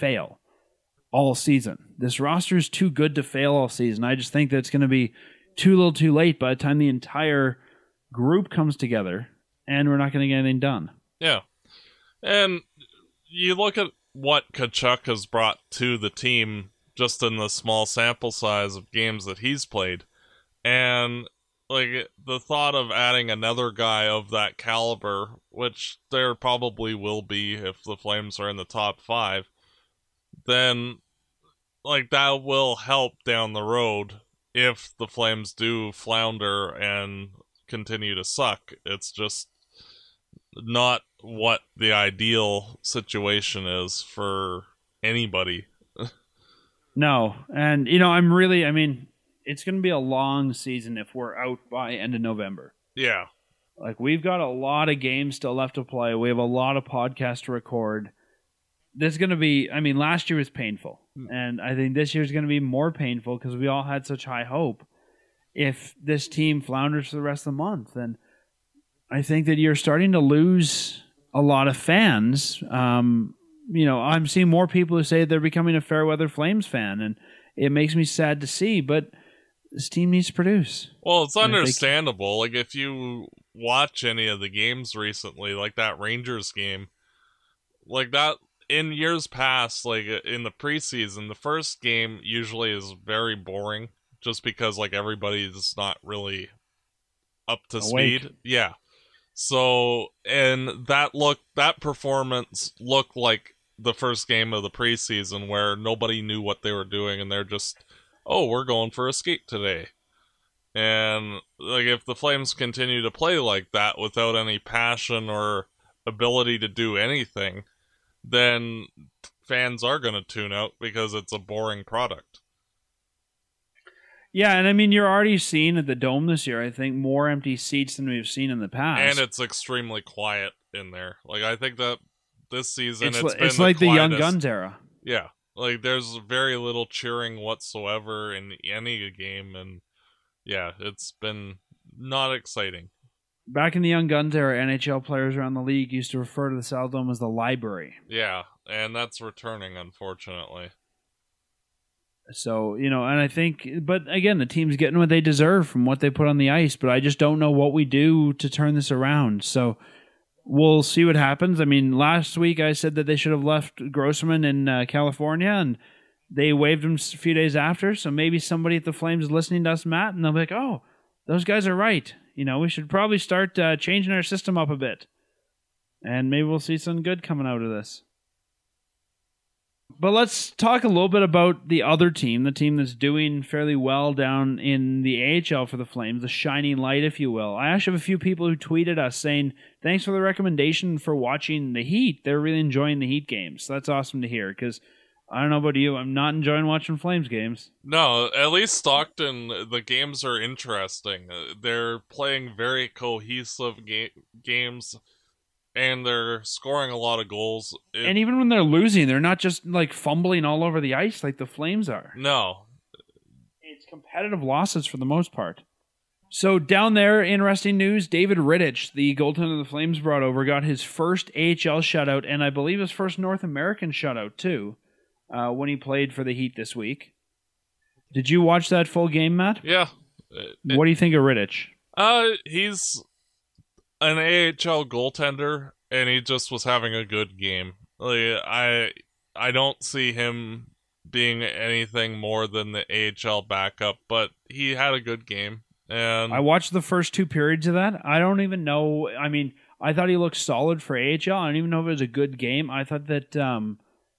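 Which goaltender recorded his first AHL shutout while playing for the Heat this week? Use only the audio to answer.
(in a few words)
David Rittich.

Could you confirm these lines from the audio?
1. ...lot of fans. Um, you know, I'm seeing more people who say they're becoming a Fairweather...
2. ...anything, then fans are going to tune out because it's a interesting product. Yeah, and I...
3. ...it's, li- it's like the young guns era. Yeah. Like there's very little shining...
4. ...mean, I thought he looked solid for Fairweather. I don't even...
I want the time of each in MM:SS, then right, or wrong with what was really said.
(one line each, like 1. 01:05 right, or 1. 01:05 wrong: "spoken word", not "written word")
1. 01:11 right
2. 01:56 wrong: "boring", not "interesting"
3. 02:13 wrong: "cheering", not "shining"
4. 04:09 wrong: "AHL", not "Fairweather".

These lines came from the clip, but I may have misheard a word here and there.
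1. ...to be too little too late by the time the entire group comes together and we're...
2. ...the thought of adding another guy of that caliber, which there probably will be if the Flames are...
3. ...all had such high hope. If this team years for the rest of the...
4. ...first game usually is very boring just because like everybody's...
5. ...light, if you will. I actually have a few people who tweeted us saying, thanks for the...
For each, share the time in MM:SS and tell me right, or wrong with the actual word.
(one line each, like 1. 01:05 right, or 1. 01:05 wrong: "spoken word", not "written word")
1. 00:04 right
2. 00:22 right
3. 01:03 wrong: "flounders", not "years"
4. 01:31 right
5. 03:06 right.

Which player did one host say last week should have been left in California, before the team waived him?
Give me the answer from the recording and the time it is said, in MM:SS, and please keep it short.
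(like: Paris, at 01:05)
Grossmann, at 02:43.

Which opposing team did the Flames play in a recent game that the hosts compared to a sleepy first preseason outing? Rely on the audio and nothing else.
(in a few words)
Rangers.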